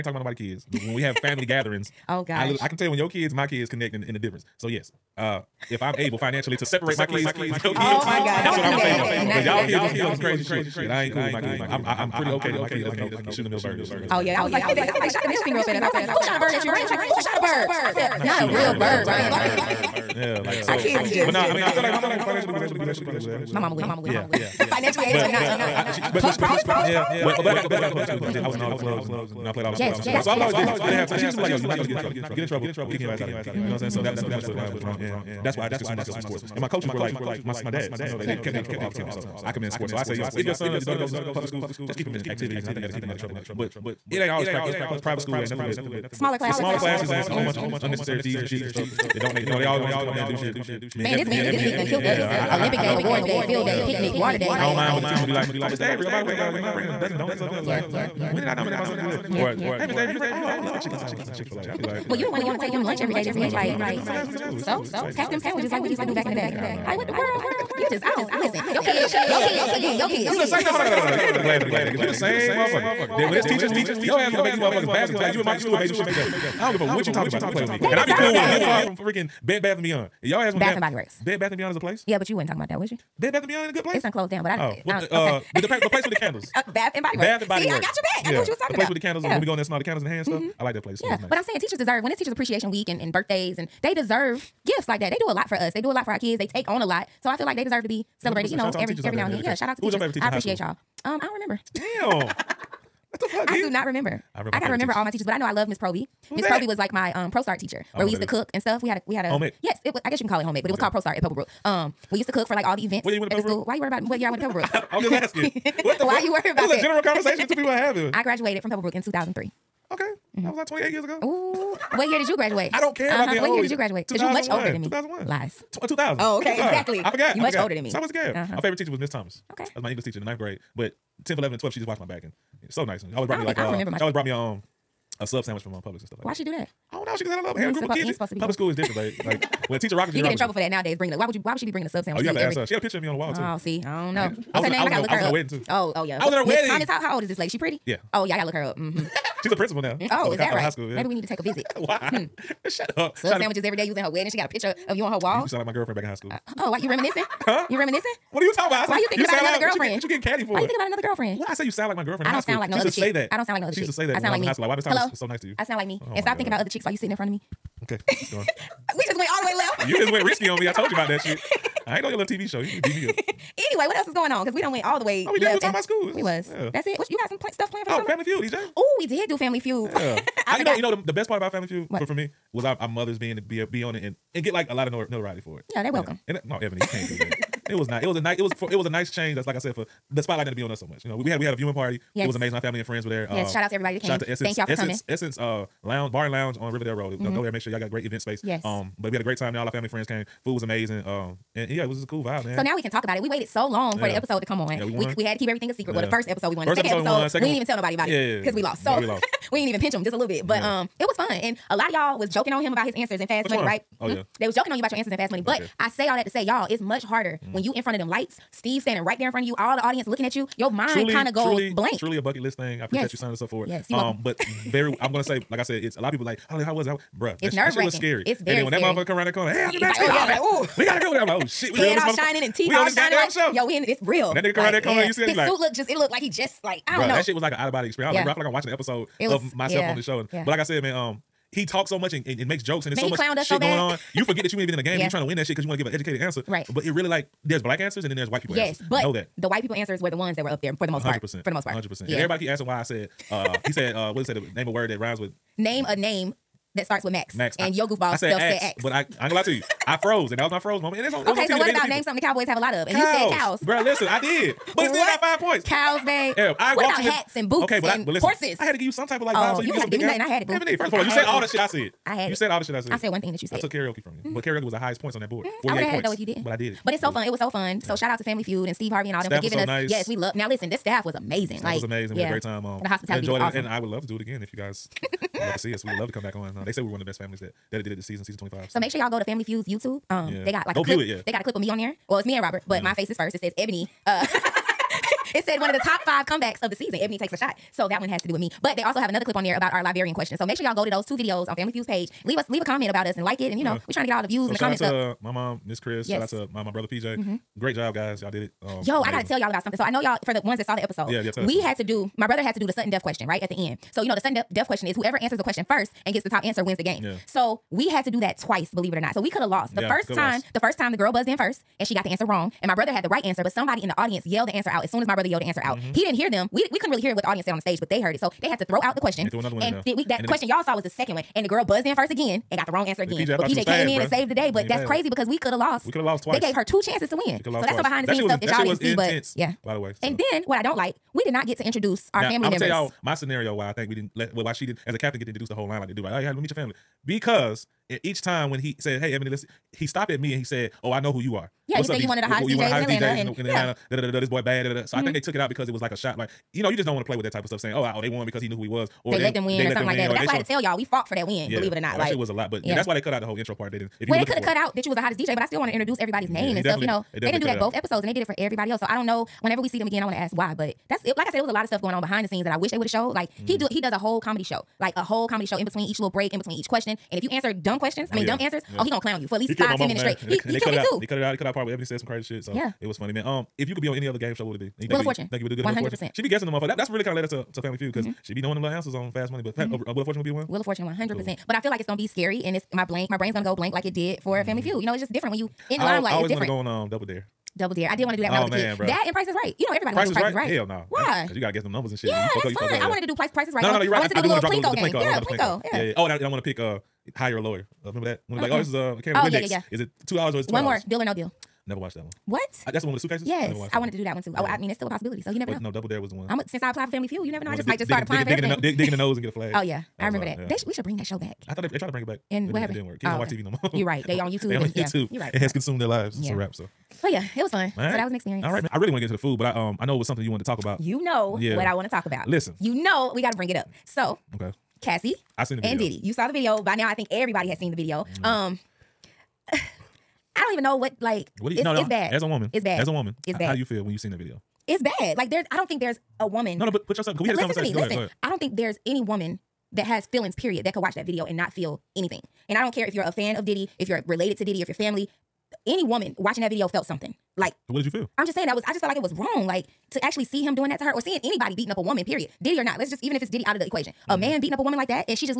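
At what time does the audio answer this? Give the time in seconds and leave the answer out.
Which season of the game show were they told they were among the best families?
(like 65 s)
288 s.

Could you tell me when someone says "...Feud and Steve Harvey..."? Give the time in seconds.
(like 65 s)
278 s.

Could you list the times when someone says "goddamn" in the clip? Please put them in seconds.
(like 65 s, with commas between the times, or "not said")
233 s.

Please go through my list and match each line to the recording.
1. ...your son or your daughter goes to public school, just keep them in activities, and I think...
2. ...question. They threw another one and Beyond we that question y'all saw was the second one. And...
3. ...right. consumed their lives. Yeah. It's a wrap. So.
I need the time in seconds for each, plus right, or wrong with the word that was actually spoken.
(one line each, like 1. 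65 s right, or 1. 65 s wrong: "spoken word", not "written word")
1. 40 s right
2. 329 s wrong: "Did", not "Beyond"
3. 425 s right.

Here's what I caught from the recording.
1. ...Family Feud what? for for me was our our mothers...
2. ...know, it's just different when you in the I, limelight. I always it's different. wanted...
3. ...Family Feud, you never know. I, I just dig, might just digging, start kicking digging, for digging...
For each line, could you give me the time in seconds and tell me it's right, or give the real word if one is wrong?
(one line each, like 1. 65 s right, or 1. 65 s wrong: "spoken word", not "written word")
1. 181 s right
2. 394 s right
3. 416 s wrong: "applying", not "kicking".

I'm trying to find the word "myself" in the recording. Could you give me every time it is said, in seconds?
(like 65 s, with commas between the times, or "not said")
36 s, 58 s, 239 s.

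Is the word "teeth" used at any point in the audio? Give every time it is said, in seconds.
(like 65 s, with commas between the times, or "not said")
232 s.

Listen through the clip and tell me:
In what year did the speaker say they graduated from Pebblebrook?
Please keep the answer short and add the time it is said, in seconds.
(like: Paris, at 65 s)
2003, at 119 s.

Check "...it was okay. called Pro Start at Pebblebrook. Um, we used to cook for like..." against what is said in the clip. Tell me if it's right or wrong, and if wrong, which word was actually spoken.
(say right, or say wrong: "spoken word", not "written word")
right.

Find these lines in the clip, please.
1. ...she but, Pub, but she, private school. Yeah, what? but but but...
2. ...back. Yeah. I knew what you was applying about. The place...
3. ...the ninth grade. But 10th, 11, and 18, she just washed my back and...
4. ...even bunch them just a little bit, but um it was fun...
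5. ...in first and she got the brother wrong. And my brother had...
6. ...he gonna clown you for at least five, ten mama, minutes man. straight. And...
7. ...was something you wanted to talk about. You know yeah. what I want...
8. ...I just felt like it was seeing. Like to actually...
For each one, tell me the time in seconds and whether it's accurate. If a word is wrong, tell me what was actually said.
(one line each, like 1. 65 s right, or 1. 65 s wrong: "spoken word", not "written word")
1. 25 s right
2. 88 s wrong: "talking", not "applying"
3. 130 s wrong: "12", not "18"
4. 209 s wrong: "pinch", not "bunch"
5. 321 s wrong: "answer", not "brother"
6. 378 s right
7. 429 s right
8. 458 s wrong: "wrong", not "seeing".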